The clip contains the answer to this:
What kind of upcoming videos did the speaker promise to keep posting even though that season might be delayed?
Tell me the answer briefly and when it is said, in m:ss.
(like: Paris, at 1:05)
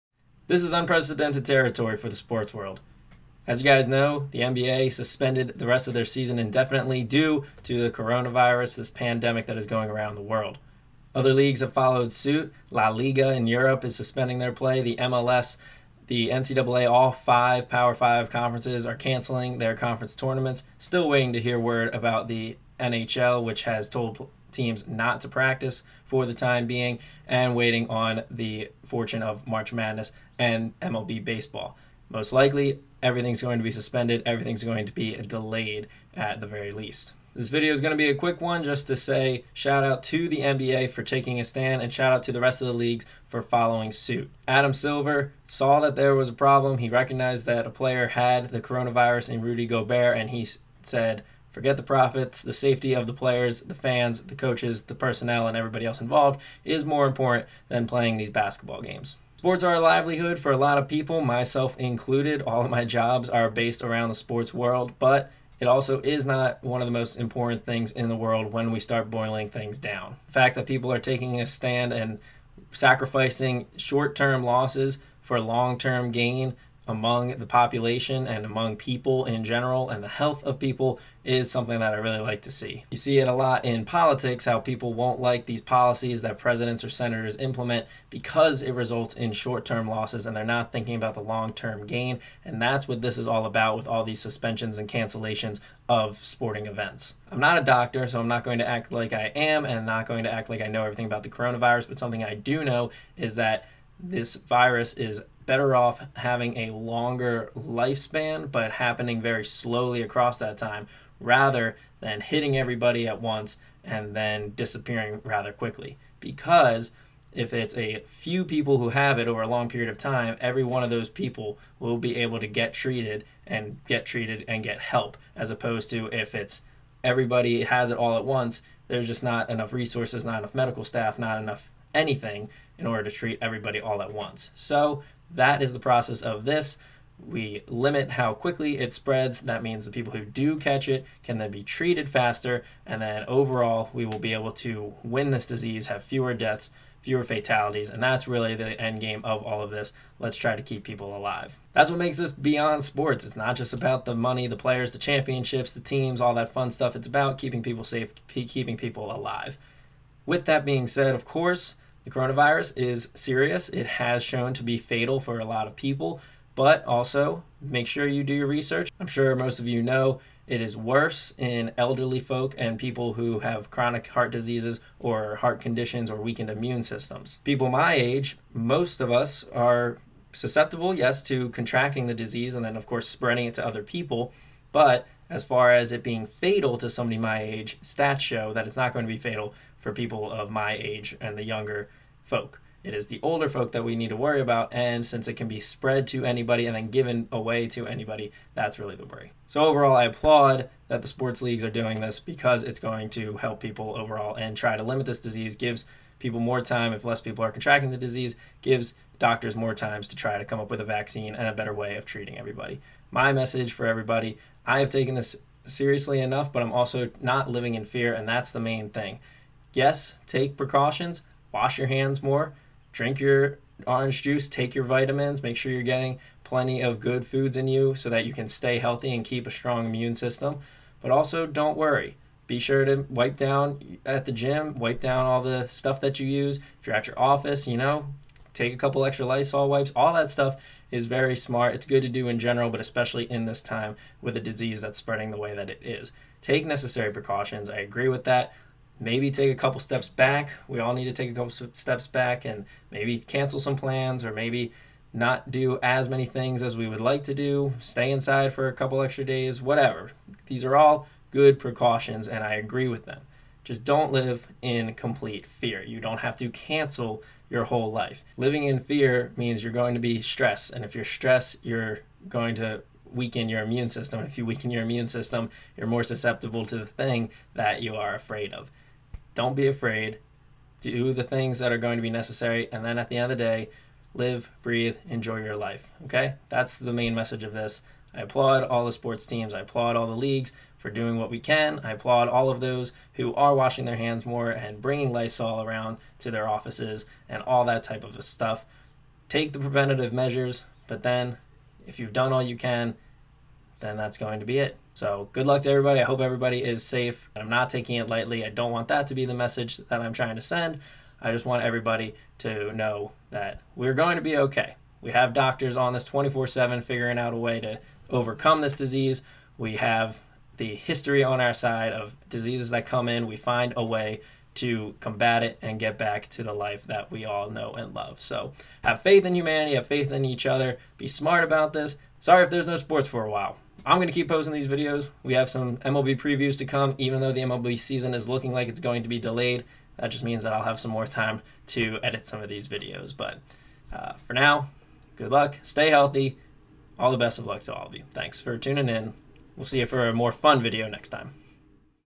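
MLB previews, at 5:35.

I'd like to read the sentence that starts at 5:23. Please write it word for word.
We find a way to combat it and get back to the life that we all know and love.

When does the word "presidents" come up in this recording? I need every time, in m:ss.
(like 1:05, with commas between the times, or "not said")
1:26.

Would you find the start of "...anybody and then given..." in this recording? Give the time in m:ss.
3:16.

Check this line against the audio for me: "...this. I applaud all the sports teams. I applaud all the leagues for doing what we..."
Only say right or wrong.
right.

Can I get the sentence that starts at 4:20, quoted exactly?
These are all good precautions and I agree with them.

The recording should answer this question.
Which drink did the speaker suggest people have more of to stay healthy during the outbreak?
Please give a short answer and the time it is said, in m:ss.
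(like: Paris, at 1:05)
Orange juice, at 3:43.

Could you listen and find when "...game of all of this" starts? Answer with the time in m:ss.
2:29.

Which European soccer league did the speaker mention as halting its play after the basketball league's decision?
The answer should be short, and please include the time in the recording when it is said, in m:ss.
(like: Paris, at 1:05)
La Liga, at 0:12.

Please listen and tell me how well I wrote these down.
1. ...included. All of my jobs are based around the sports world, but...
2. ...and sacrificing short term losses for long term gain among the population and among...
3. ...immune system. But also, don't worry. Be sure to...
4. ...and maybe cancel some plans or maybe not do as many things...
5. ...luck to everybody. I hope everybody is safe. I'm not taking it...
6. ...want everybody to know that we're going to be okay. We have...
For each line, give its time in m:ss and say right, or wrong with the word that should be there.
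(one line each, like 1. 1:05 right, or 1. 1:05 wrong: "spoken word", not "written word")
1. 1:01 right
2. 1:11 right
3. 3:49 right
4. 4:12 right
5. 5:05 right
6. 5:11 right.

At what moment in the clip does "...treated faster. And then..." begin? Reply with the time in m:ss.
2:21.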